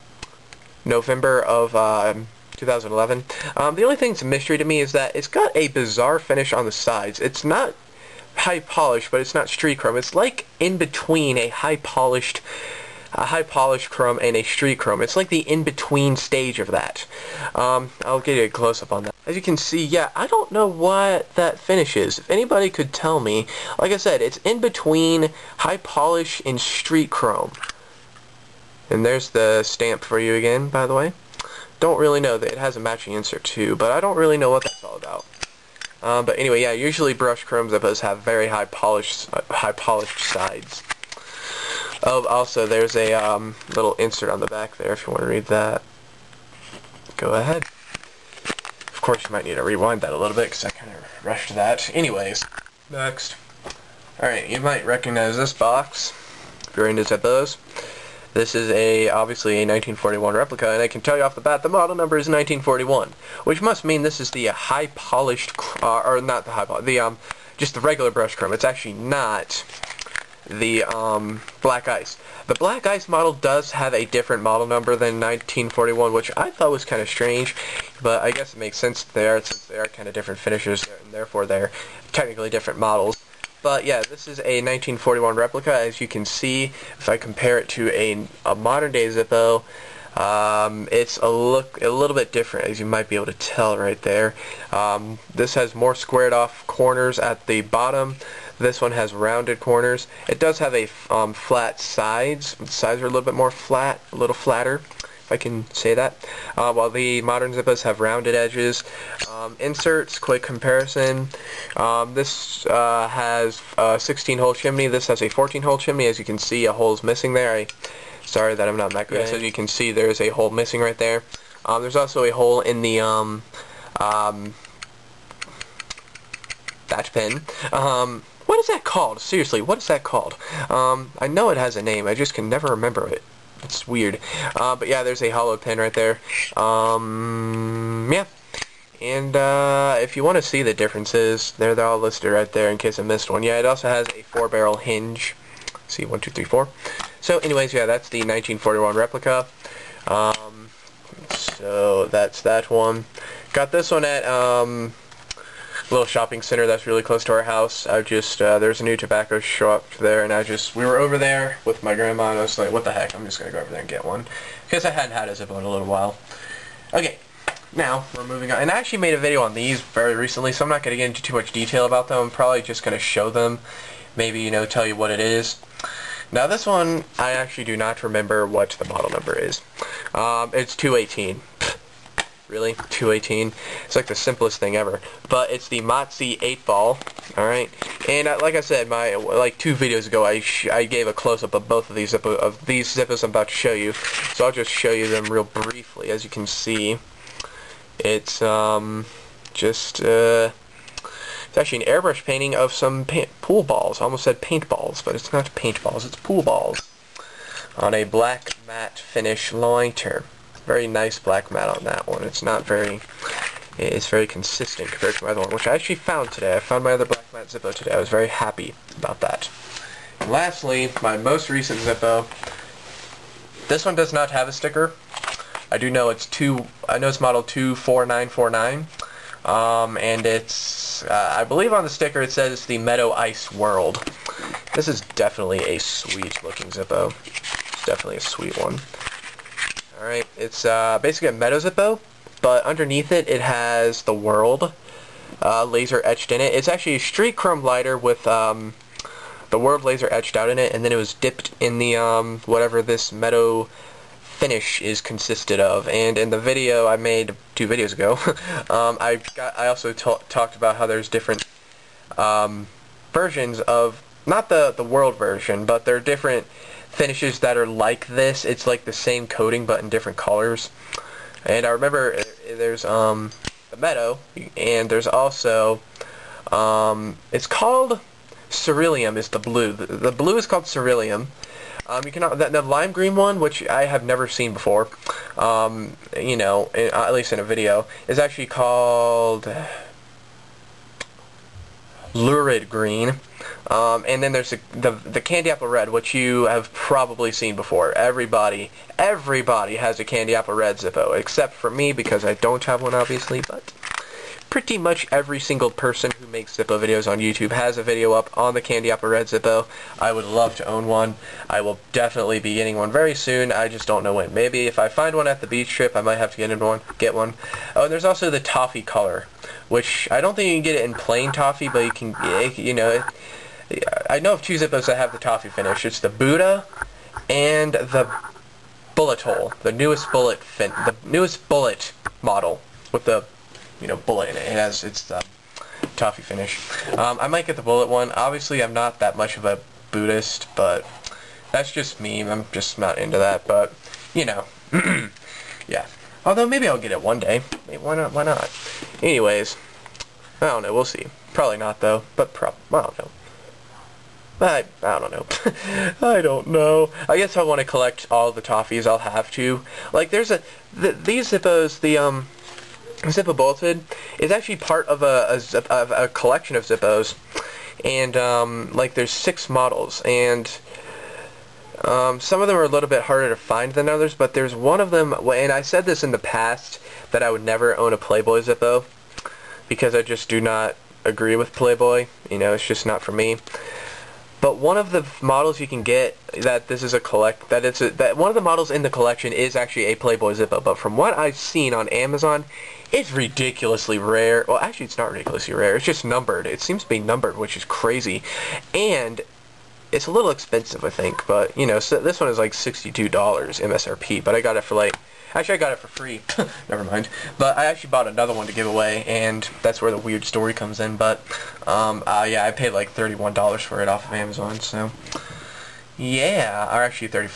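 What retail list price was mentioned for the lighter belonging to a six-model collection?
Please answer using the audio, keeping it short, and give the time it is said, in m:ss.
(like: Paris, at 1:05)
$62, at 6:42.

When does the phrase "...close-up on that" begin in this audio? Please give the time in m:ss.
0:18.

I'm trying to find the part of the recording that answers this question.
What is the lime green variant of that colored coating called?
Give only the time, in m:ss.
4:52.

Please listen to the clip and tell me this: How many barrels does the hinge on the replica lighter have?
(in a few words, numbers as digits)
4.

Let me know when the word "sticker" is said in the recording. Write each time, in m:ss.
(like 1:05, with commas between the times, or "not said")
3:44, 3:51.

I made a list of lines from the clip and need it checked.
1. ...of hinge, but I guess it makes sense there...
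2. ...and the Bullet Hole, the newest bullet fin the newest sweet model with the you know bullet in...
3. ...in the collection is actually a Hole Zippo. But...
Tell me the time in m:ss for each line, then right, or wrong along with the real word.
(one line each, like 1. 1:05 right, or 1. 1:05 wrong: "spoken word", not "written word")
1. 1:17 wrong: "strange", not "hinge"
2. 5:27 wrong: "bullet", not "sweet"
3. 6:28 wrong: "Playboy", not "Hole".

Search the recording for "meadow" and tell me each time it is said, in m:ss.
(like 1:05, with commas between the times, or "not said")
3:52, 4:01, 4:13, 4:33.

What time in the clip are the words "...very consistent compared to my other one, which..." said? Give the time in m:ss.
3:34.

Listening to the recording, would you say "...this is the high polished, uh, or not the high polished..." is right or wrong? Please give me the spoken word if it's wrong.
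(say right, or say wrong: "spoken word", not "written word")
right.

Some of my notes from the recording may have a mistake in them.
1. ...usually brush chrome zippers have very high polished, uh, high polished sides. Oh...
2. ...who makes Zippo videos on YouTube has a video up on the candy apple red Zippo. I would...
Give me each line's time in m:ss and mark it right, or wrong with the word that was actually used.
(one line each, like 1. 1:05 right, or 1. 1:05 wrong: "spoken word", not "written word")
1. 0:36 right
2. 5:06 right.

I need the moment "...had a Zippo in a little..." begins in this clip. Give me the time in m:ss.
2:45.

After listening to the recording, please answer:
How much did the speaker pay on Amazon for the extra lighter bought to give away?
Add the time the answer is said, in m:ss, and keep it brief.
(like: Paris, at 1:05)
$31, at 6:52.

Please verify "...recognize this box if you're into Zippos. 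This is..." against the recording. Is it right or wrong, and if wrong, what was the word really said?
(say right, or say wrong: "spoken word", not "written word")
right.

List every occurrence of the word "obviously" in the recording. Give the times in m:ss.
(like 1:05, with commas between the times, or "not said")
0:59, 5:02, 5:38.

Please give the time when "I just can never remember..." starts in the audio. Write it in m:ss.
2:12.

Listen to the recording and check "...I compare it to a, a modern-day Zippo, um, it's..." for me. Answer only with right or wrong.
right.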